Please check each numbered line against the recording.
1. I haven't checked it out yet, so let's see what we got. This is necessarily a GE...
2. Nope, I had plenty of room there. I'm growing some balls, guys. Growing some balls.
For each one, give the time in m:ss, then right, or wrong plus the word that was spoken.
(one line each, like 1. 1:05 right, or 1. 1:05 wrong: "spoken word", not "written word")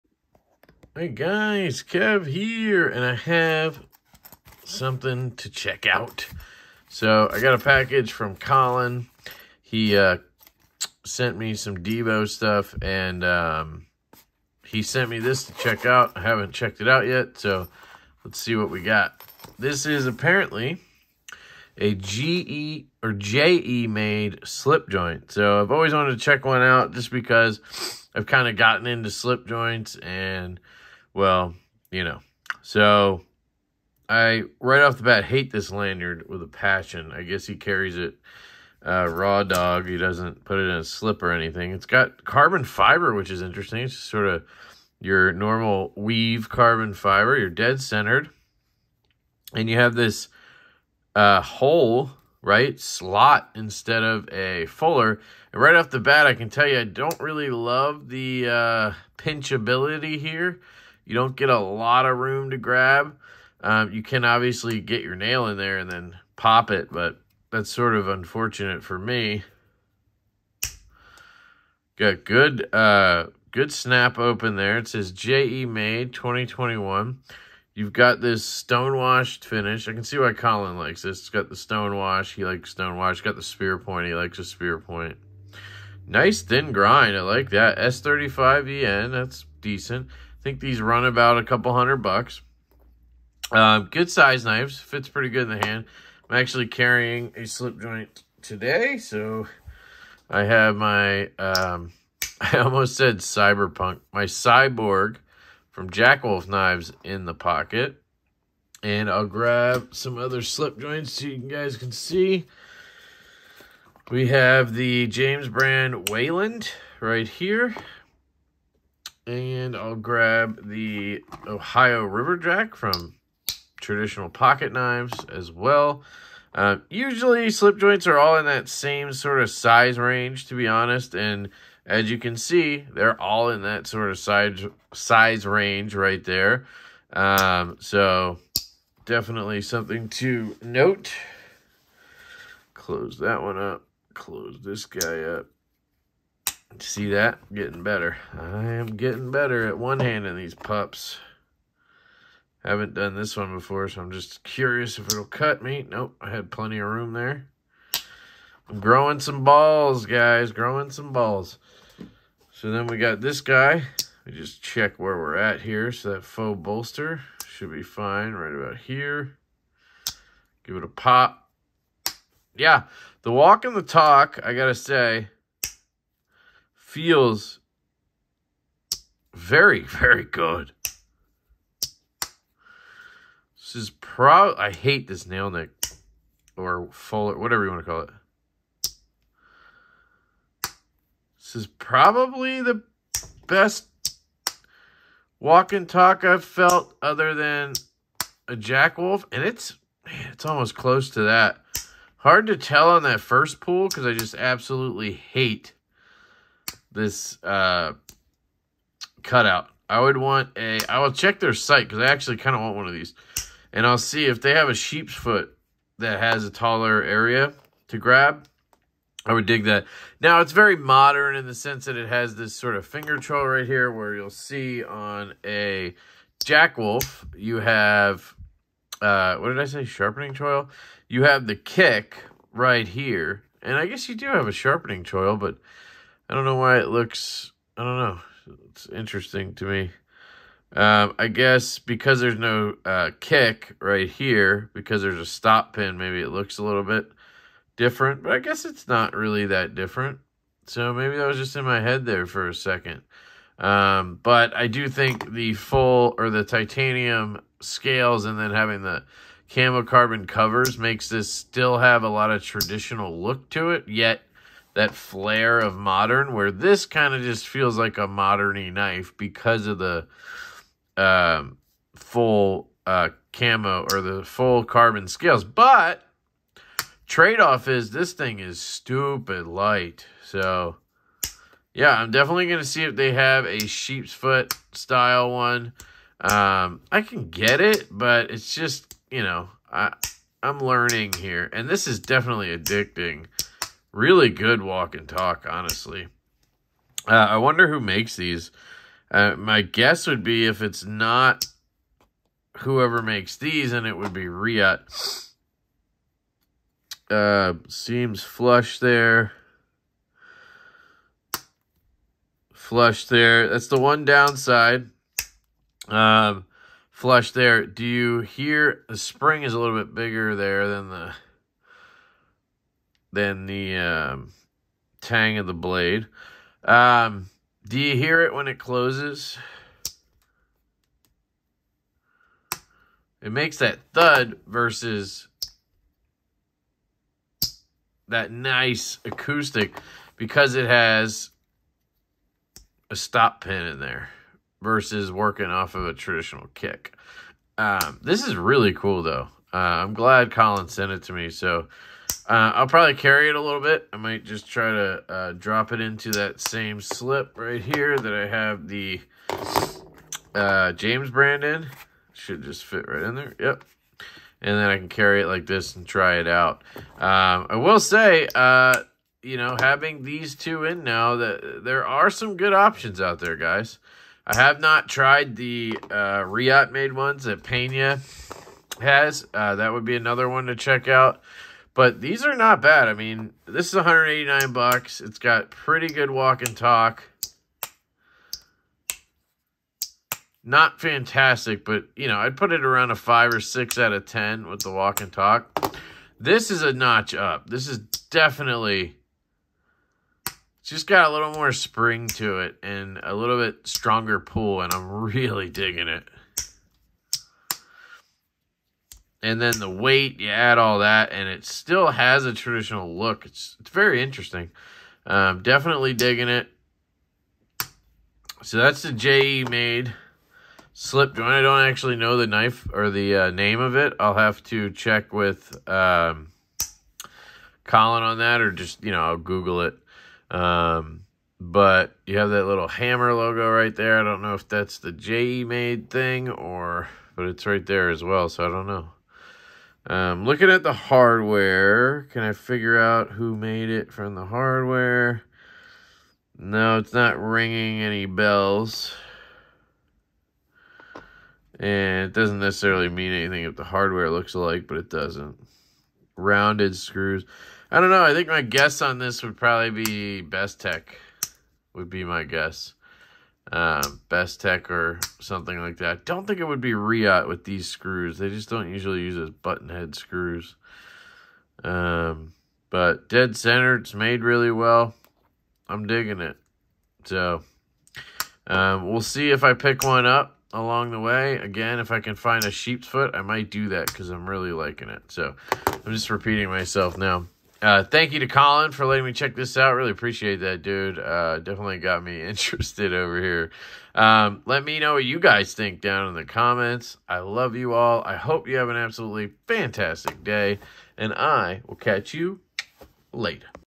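1. 0:16 wrong: "apparently", not "necessarily"
2. 2:35 right.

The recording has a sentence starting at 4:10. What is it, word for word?
So maybe that was just in my head there for a second.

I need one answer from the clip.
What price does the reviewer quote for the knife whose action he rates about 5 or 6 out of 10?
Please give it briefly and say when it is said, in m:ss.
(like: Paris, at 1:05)
$189, at 6:23.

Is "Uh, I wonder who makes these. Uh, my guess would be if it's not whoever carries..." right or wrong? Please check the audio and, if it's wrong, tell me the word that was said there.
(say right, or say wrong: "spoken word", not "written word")
wrong: "makes", not "carries".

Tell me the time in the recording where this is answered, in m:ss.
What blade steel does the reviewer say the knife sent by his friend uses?
1:27.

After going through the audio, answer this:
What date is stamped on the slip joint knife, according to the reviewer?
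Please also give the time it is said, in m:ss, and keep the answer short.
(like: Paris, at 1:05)
May 2021, at 1:15.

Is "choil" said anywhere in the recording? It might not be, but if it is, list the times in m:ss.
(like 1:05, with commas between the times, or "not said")
3:43, 3:50, 3:55.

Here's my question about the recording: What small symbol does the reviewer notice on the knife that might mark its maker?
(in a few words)
hammer logo.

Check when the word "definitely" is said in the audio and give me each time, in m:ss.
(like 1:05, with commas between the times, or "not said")
2:19, 4:42, 4:51, 6:37, 6:55, 8:11.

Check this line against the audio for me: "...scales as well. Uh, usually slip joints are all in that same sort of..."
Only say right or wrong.
wrong.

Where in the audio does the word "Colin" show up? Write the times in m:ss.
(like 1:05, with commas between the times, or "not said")
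0:08, 1:20, 5:50, 7:07, 8:08.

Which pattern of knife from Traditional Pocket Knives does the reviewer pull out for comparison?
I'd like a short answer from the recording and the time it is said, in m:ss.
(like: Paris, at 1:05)
Ohio River Jack, at 2:01.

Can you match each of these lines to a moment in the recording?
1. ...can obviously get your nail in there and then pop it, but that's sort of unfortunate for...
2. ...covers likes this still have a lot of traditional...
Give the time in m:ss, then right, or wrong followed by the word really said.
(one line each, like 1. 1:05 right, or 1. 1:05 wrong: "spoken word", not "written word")
1. 1:04 right
2. 4:20 wrong: "makes", not "likes".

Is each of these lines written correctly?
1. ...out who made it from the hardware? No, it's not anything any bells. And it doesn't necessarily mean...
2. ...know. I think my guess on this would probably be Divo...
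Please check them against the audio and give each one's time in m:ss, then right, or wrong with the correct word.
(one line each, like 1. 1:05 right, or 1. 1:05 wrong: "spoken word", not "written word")
1. 7:22 wrong: "ringing", not "anything"
2. 7:37 wrong: "Bestech", not "Divo".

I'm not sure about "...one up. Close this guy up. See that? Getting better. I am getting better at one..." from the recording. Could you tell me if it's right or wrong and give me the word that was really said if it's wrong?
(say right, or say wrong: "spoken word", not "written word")
right.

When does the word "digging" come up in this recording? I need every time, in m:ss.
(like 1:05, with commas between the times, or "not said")
6:45, 6:55, 7:55.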